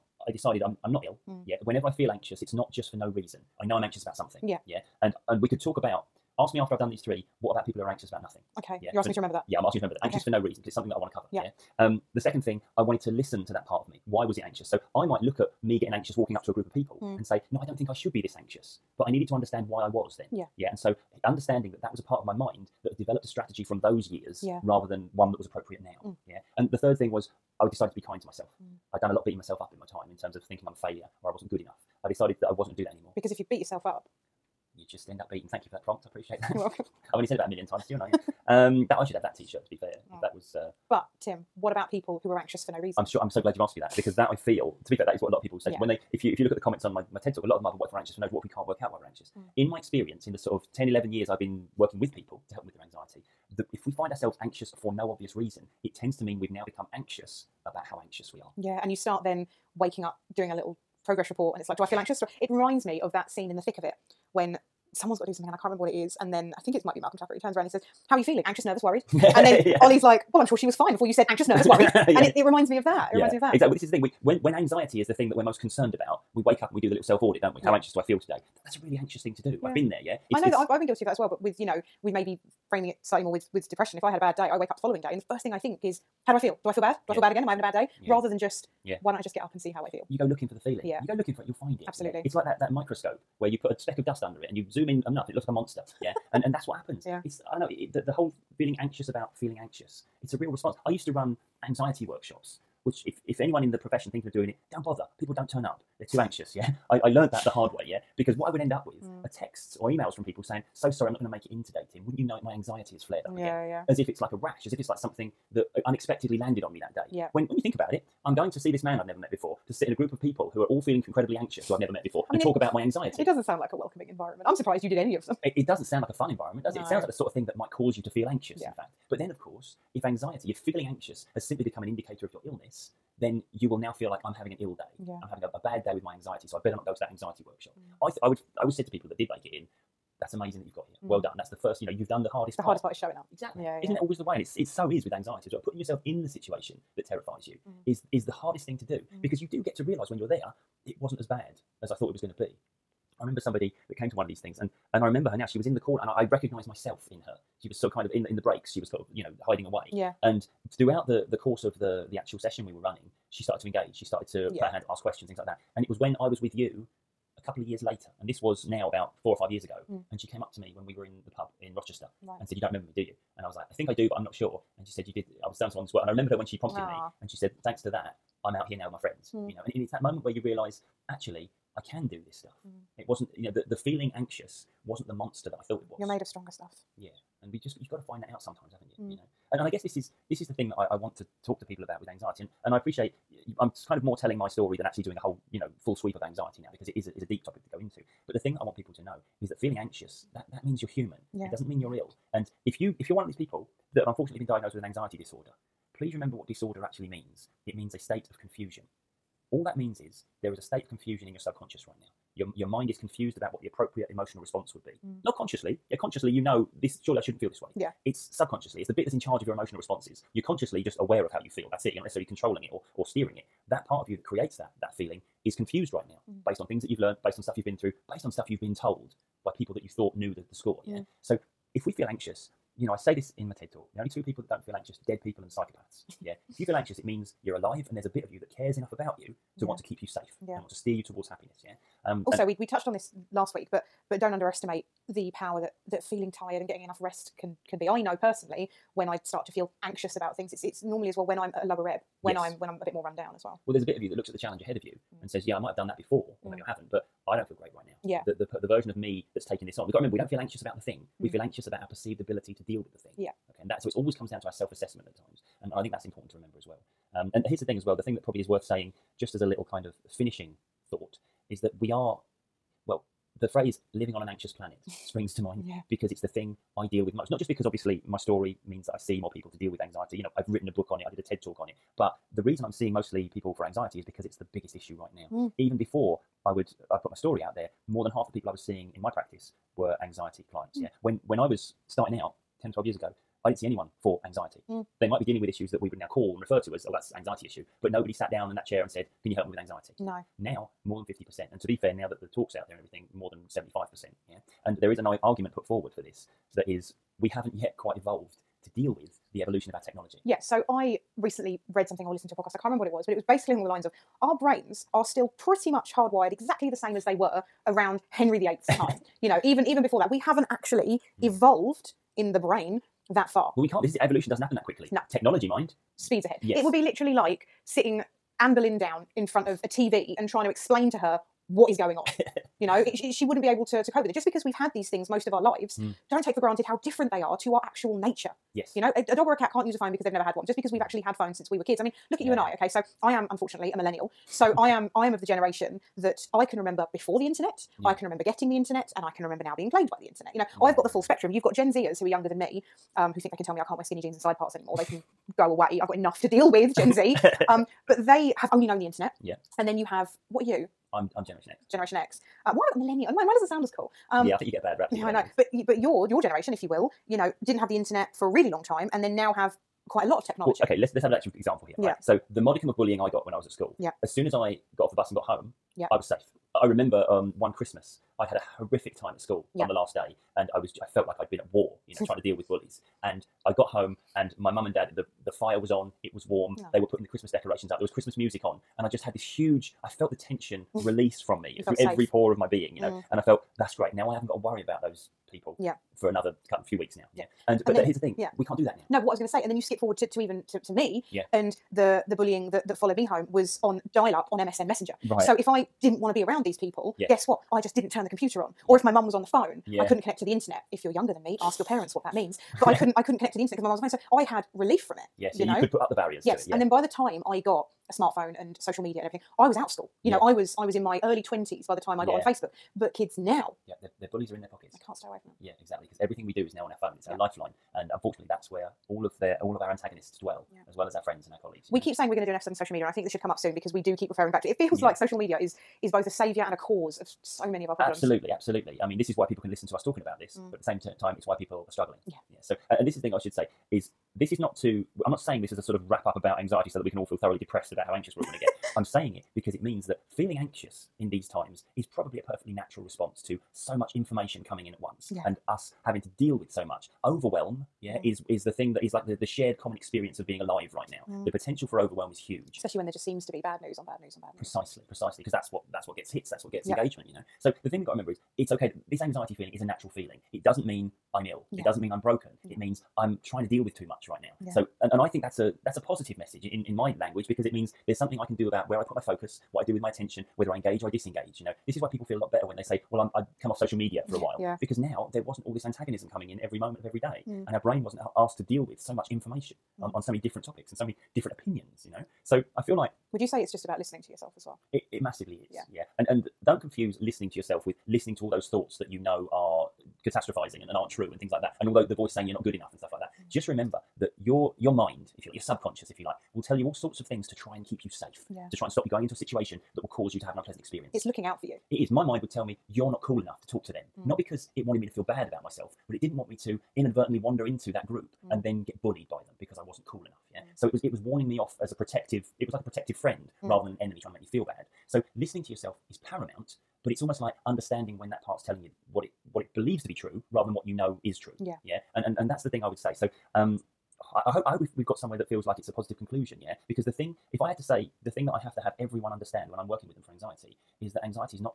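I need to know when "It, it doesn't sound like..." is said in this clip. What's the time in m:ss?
2:05.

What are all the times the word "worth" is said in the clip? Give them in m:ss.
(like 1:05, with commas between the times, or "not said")
4:28.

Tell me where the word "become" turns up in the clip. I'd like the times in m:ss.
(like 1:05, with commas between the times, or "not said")
0:56, 2:11.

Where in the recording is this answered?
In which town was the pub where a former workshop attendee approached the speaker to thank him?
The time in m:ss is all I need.
2:51.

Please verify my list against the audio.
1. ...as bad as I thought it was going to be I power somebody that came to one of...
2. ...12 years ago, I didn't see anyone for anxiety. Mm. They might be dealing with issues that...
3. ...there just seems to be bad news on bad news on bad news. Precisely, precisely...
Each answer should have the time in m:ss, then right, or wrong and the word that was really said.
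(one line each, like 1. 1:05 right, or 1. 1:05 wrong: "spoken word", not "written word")
1. 2:31 wrong: "remember", not "power"
2. 4:52 right
3. 7:42 right.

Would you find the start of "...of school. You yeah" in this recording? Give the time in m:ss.
6:59.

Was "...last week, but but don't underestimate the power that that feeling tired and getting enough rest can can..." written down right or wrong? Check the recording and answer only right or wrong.
right.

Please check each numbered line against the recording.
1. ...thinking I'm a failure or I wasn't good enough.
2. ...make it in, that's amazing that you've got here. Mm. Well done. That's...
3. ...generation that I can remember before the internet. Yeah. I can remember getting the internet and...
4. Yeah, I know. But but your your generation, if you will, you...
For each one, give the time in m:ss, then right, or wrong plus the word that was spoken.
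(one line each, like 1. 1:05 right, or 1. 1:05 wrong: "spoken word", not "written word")
1. 0:30 right
2. 2:19 right
3. 5:45 right
4. 6:04 right.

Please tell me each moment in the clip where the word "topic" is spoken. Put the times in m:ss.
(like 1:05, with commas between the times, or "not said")
3:17, 8:10.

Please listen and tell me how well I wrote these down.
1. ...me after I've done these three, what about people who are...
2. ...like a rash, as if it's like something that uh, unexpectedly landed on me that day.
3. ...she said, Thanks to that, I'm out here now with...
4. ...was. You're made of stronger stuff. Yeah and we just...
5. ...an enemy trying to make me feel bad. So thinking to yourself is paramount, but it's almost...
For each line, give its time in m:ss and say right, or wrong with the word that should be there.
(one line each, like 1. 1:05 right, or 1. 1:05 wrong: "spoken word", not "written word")
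1. 0:06 right
2. 1:54 right
3. 2:57 right
4. 3:05 right
5. 8:43 wrong: "listening", not "thinking".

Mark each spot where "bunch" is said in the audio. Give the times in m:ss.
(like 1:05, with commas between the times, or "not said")
not said.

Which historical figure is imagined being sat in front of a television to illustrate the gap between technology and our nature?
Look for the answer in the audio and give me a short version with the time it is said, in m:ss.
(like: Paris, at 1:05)
Anne Boleyn, at 5:28.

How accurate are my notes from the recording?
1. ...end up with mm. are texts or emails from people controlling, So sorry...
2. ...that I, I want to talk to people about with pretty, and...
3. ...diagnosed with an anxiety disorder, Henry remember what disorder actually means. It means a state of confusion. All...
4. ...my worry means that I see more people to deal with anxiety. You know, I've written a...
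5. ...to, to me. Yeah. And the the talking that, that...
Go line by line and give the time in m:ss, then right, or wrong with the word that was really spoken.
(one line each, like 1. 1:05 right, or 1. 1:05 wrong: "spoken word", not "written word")
1. 1:48 wrong: "saying", not "controlling"
2. 3:10 wrong: "anxiety", not "pretty"
3. 3:24 wrong: "Please", not "Henry"
4. 4:38 wrong: "story", not "worry"
5. 6:40 wrong: "bullying", not "talking".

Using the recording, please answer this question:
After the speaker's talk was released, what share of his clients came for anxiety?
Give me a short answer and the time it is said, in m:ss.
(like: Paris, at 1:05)
More than 75%, at 5:03.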